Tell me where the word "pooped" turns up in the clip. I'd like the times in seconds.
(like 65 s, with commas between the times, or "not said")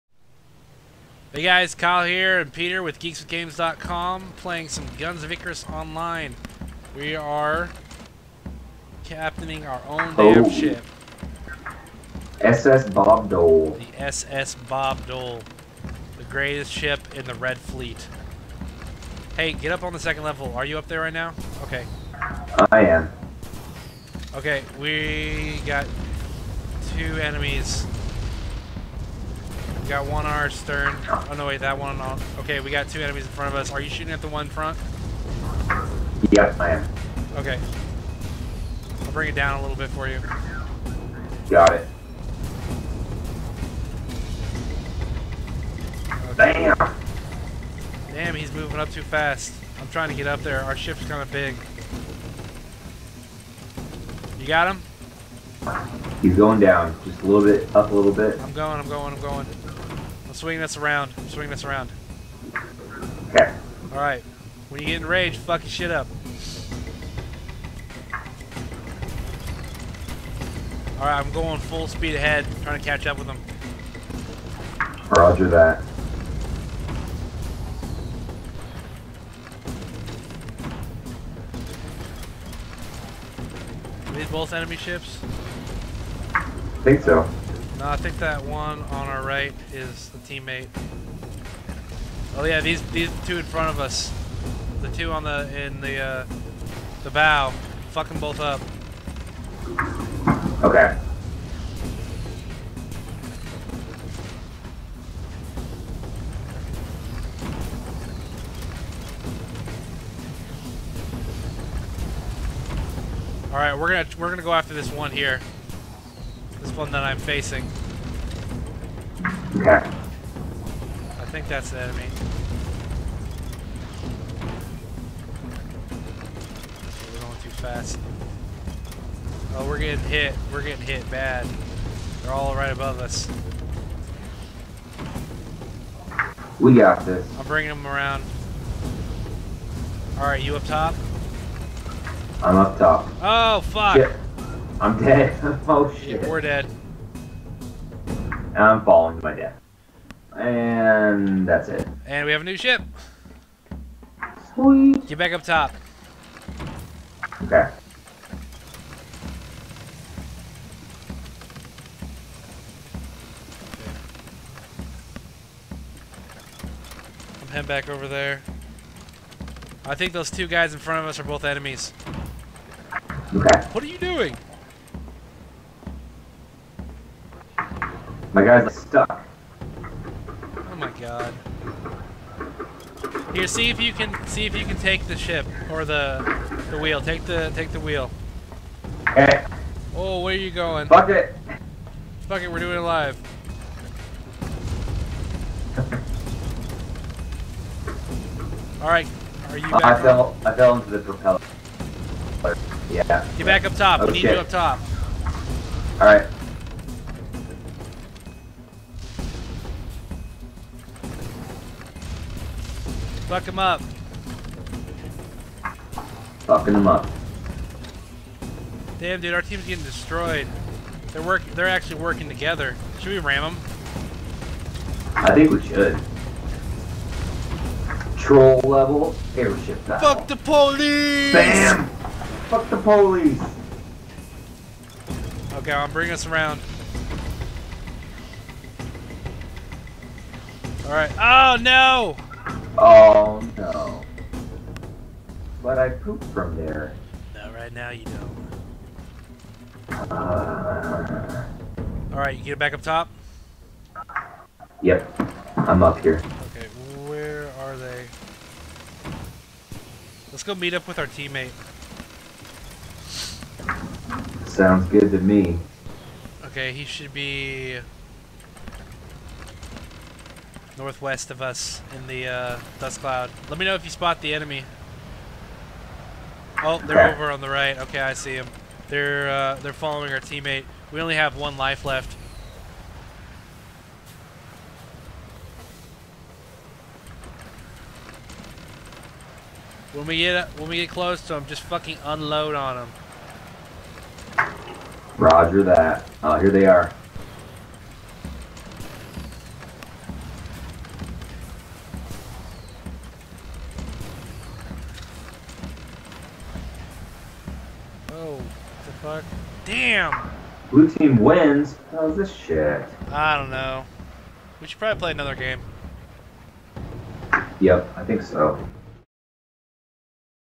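245 s.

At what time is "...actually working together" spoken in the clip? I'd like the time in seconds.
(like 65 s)
221 s.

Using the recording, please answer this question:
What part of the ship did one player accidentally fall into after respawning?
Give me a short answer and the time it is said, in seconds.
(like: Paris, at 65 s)
The propeller, at 200 s.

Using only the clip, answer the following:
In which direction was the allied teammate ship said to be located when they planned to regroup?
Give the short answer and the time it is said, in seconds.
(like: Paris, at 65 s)
Northwest, at 270 s.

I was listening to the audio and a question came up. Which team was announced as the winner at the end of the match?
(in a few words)
Blue team.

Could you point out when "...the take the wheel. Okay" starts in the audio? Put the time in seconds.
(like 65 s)
187 s.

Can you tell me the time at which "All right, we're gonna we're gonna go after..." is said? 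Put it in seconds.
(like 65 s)
113 s.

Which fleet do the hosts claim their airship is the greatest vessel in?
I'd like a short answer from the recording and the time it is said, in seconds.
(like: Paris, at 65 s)
Red Fleet, at 17 s.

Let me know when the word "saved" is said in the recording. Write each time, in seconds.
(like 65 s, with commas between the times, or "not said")
not said.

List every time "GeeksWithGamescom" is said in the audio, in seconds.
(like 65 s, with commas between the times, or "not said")
2 s.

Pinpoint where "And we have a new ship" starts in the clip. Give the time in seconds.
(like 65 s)
152 s.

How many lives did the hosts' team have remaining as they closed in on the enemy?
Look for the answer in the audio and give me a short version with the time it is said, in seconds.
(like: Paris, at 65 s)
1, at 281 s.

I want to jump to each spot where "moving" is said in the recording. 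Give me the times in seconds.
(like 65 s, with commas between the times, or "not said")
48 s.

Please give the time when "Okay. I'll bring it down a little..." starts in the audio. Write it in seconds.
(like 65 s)
37 s.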